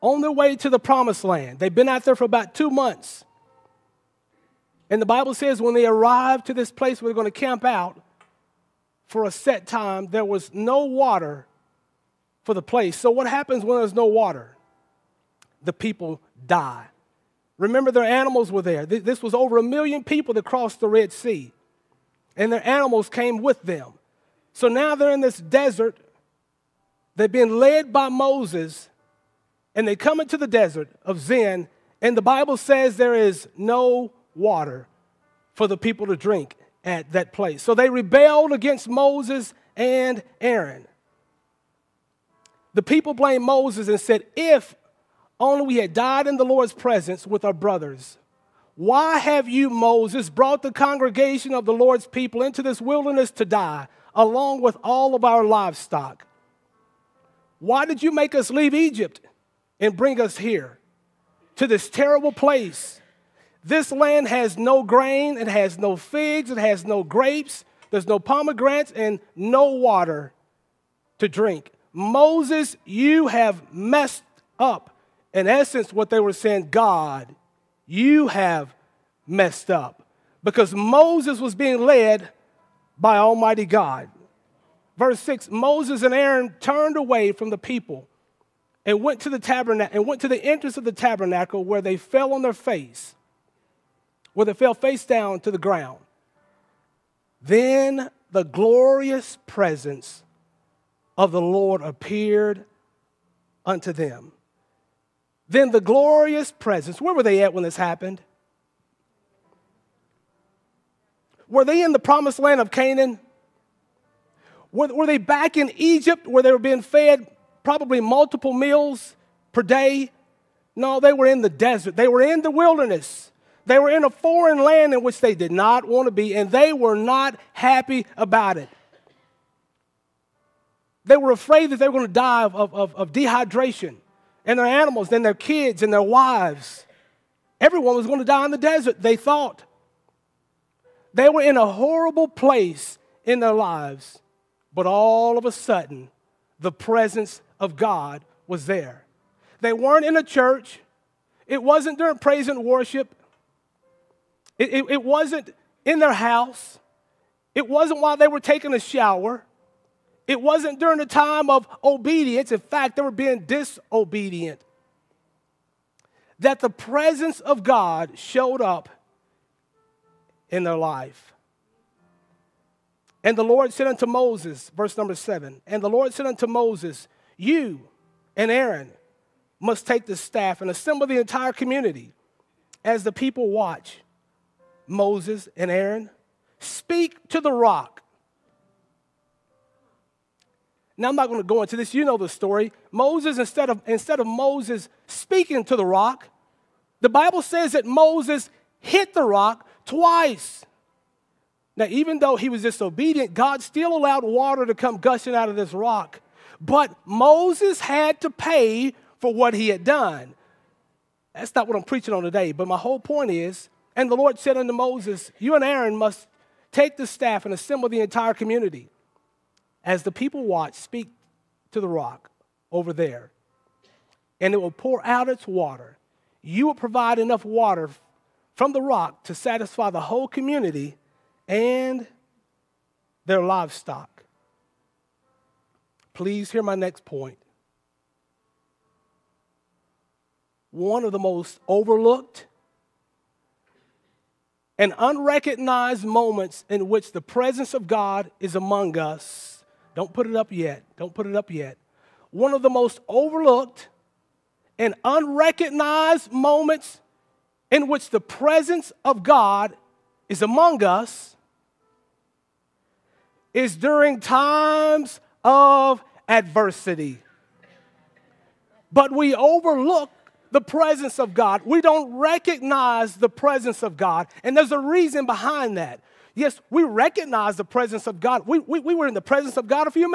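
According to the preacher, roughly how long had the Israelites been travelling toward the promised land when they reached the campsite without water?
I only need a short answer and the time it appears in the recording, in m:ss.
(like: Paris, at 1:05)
about two months, at 0:02.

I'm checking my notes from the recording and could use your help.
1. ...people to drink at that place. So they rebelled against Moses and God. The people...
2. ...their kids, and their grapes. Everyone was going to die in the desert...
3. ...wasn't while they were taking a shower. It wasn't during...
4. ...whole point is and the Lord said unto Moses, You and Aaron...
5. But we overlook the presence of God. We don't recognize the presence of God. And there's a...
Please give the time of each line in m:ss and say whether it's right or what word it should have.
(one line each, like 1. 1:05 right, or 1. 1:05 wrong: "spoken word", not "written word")
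1. 0:35 wrong: "Aaron", not "God"
2. 2:15 wrong: "wives", not "grapes"
3. 2:37 right
4. 3:32 right
5. 4:28 right.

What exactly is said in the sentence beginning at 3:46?
You will provide enough water from the rock to satisfy the whole community and their livestock.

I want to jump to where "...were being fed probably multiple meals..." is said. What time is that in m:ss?
1:56.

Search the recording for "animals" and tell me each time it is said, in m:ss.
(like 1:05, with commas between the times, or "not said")
0:18, 0:22, 2:14.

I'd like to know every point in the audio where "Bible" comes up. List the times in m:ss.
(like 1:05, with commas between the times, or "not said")
0:05, 0:32, 3:17.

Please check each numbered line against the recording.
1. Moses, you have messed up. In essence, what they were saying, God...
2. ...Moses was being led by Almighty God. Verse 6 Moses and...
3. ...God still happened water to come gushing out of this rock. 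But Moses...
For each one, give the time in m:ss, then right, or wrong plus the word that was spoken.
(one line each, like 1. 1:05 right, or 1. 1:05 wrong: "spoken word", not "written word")
1. 1:11 right
2. 1:20 right
3. 3:23 wrong: "allowed", not "happened".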